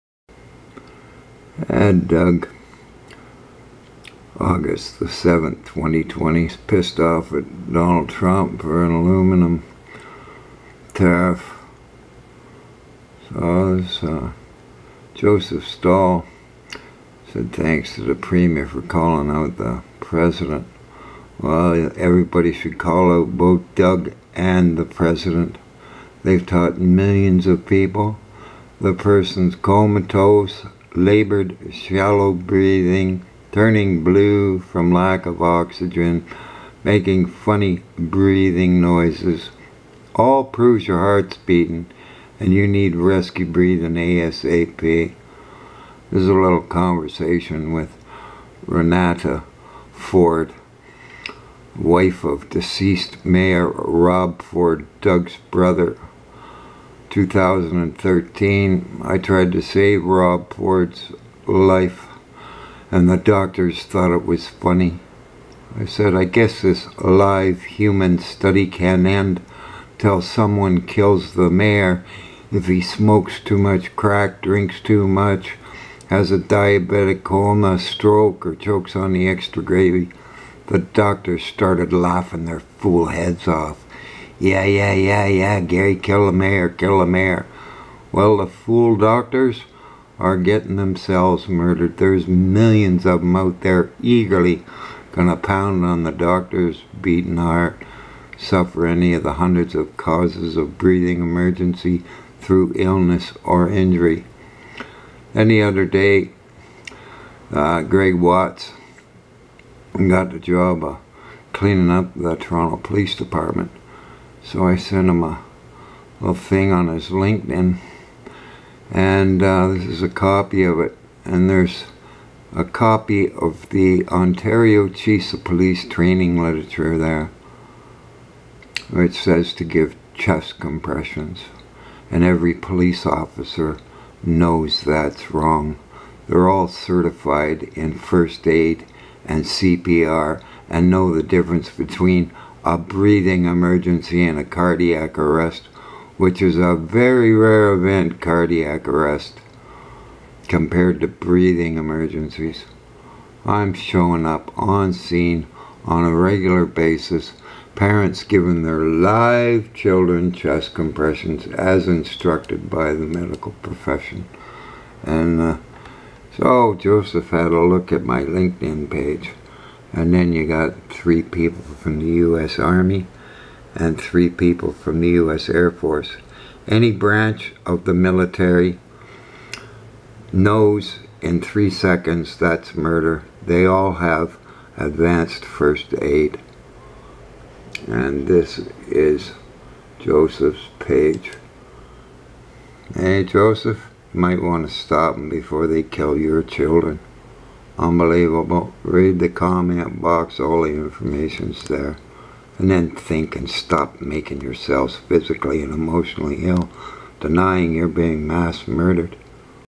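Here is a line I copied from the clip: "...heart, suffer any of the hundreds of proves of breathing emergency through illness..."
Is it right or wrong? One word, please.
wrong.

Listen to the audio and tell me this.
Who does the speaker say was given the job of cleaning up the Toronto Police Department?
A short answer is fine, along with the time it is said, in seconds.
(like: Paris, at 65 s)
Greg Watts, at 107 s.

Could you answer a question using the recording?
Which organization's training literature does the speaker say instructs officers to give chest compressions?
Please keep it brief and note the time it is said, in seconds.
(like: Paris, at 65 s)
Ontario Chiefs of Police, at 124 s.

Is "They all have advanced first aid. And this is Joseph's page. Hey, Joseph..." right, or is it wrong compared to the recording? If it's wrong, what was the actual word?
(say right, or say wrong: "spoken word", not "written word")
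right.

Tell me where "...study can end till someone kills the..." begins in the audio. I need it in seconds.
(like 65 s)
68 s.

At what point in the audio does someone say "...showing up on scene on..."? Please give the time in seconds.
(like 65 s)
153 s.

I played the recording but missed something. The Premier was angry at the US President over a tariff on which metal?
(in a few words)
aluminum.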